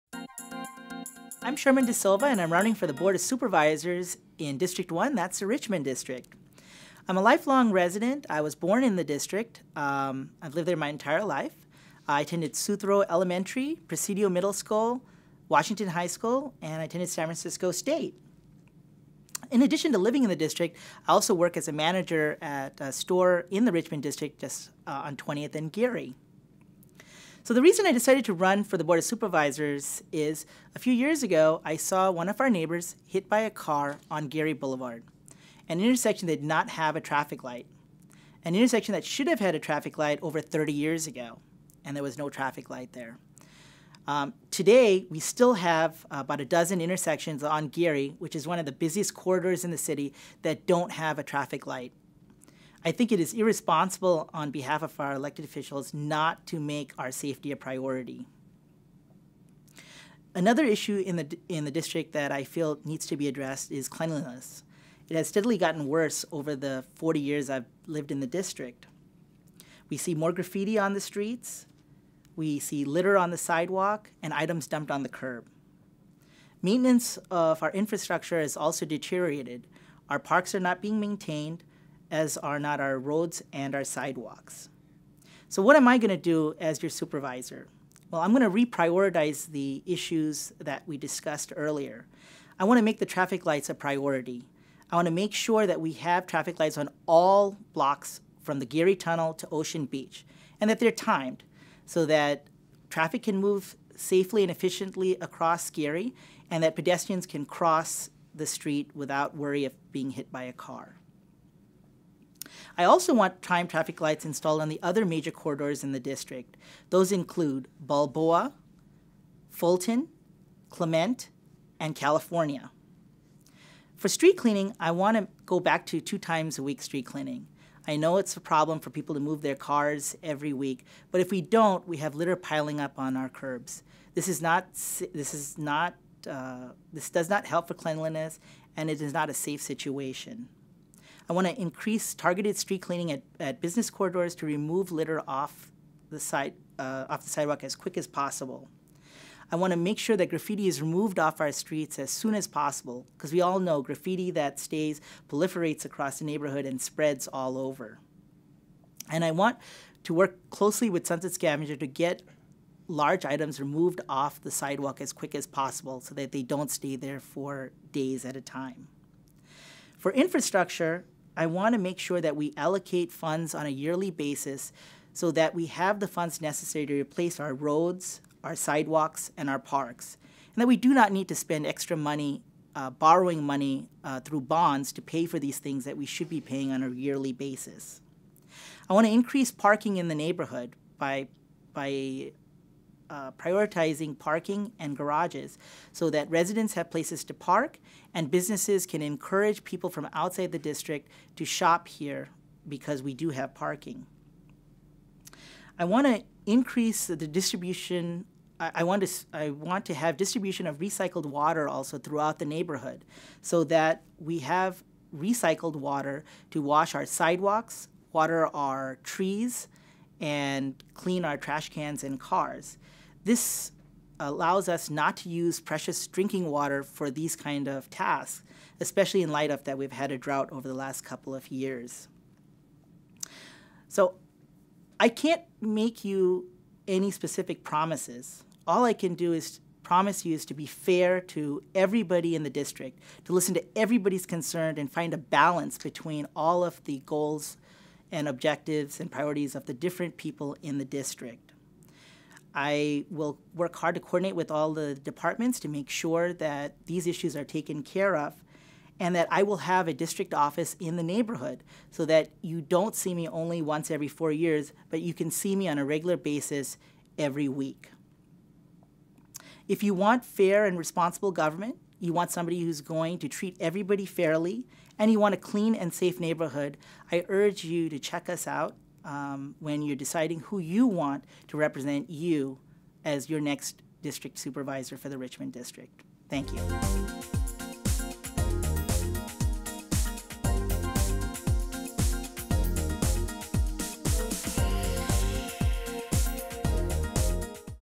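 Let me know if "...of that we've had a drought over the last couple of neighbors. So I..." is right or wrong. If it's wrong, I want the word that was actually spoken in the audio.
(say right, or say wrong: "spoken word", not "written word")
wrong: "years", not "neighbors".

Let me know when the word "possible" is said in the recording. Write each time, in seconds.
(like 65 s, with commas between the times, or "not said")
148 s, 152 s, 165 s.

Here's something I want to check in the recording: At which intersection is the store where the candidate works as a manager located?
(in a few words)
20th and Geary.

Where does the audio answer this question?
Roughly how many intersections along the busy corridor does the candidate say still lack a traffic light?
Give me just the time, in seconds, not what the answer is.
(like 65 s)
46 s.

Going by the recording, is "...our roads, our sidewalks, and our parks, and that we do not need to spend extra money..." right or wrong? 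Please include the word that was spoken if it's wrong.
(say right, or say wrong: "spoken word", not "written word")
right.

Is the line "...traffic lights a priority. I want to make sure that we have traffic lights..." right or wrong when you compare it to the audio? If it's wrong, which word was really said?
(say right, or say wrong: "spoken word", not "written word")
right.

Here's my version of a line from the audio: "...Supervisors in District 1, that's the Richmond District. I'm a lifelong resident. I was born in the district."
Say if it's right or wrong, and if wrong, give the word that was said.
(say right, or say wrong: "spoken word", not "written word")
right.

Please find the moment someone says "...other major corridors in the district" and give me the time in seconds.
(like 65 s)
114 s.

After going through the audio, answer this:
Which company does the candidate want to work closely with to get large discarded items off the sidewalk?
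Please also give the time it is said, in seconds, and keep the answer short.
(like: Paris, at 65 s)
Sunset Scavenger, at 161 s.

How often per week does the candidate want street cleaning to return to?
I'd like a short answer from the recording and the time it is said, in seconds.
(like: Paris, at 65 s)
2 times a week, at 126 s.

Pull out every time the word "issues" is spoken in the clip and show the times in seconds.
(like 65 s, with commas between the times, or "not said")
60 s, 89 s, 257 s.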